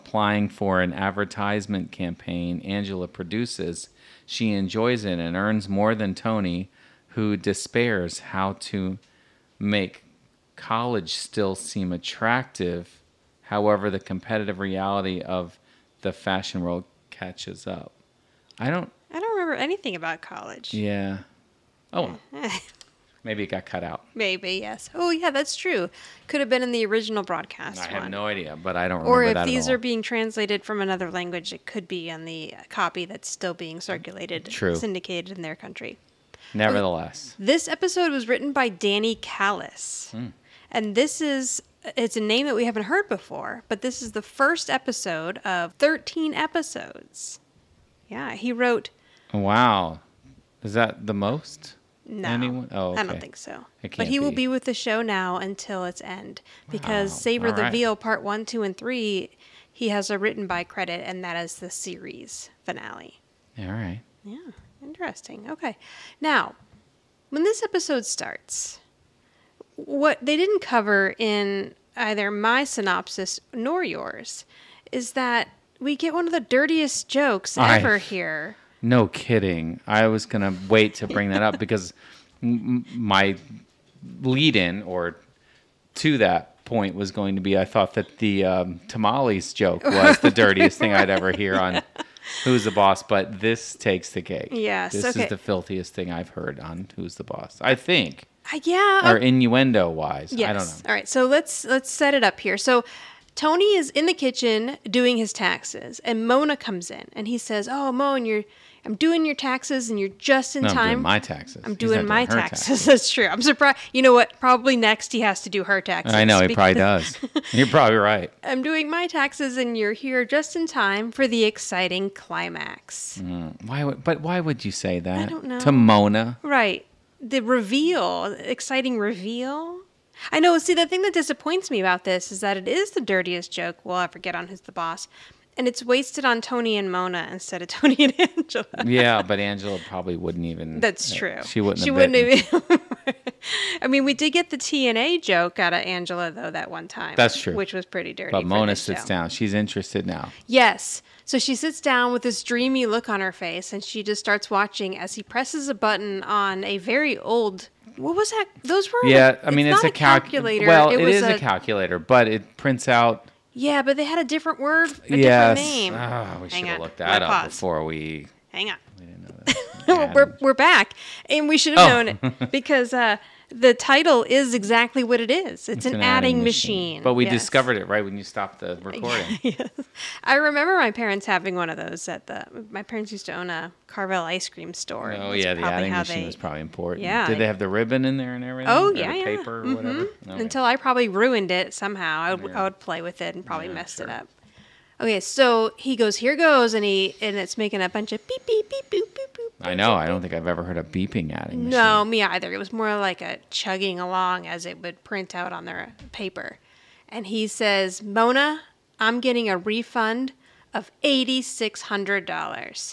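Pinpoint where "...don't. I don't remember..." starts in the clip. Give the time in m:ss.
0:18.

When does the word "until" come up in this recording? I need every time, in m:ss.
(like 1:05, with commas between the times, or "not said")
0:55, 3:10.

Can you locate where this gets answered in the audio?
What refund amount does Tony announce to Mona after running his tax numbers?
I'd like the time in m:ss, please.
3:31.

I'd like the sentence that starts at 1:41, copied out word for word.
So let's let's set it up here.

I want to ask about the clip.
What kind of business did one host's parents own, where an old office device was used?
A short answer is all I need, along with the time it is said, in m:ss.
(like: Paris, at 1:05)
Carvel ice cream store, at 3:03.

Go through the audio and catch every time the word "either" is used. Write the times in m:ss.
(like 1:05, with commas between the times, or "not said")
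1:11, 3:22.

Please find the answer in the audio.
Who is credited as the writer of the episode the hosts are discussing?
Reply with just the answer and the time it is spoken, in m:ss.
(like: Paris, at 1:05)
Danny Kallis, at 0:38.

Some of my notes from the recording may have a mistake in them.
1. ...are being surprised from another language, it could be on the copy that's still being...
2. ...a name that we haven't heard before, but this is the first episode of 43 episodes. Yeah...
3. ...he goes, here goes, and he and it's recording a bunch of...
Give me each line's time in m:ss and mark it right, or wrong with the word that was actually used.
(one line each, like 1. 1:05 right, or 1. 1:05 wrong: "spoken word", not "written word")
1. 0:29 wrong: "translated", not "surprised"
2. 0:42 wrong: "13", not "43"
3. 3:15 wrong: "making", not "recording".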